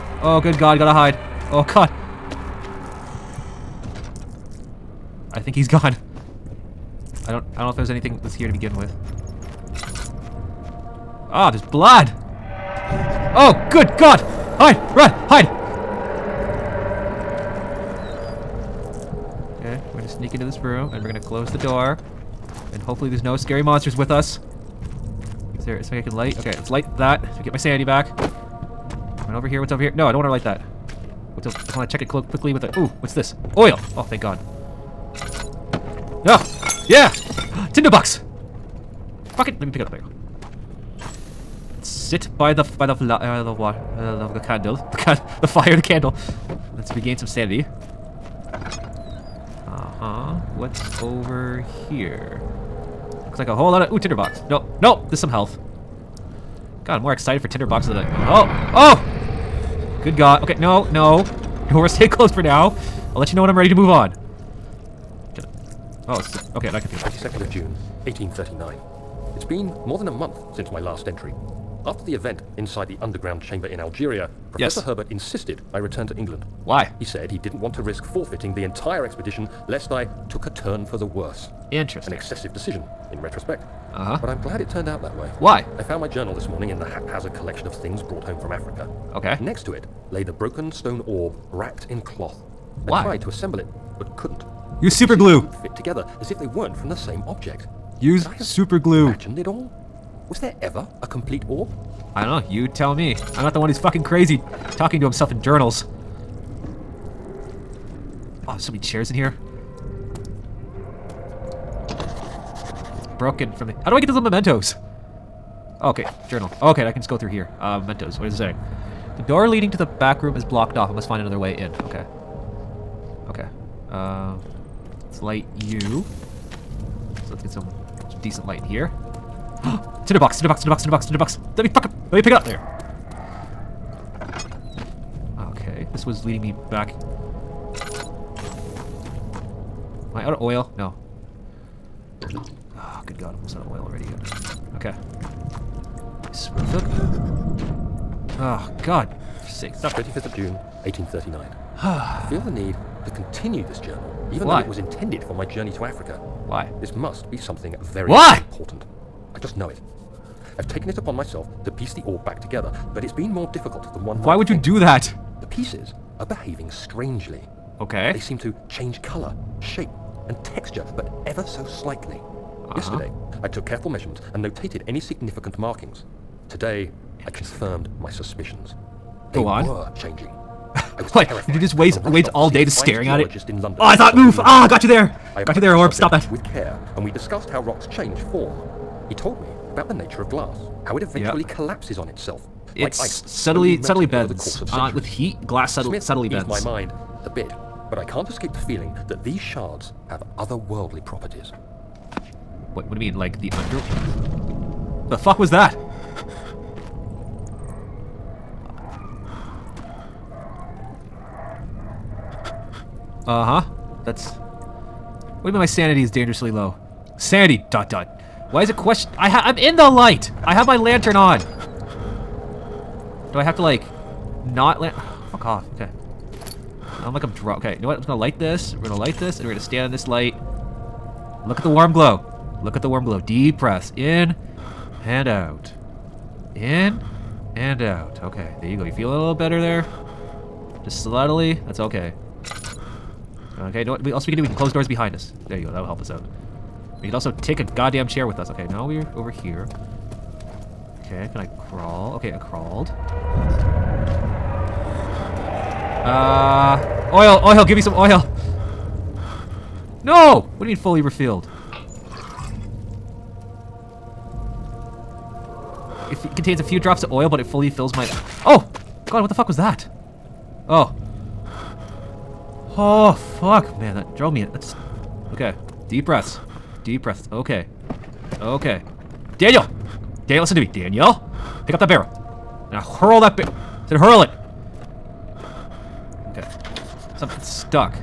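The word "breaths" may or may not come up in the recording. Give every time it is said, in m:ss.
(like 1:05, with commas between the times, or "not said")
3:53, 4:36.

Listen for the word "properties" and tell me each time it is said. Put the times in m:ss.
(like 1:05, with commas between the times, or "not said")
3:21.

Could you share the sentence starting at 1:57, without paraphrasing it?
Uh, mementos, what is it saying?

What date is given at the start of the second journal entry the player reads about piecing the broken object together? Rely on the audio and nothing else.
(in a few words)
25th of June, 1839.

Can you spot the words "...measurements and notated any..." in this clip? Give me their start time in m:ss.
2:53.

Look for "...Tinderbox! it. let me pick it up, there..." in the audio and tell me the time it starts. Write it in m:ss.
0:37.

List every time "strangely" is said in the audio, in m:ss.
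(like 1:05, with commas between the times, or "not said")
2:46.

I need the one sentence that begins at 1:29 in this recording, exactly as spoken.
Next to it lay the broken stone orb wrapped in cloth.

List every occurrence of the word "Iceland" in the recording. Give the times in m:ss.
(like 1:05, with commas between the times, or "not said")
not said.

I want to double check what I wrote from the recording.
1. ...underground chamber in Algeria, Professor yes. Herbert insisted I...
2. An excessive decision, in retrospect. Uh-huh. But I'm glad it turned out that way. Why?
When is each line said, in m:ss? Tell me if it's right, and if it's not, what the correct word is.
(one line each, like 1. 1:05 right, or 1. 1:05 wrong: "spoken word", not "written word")
1. 1:13 right
2. 1:22 right.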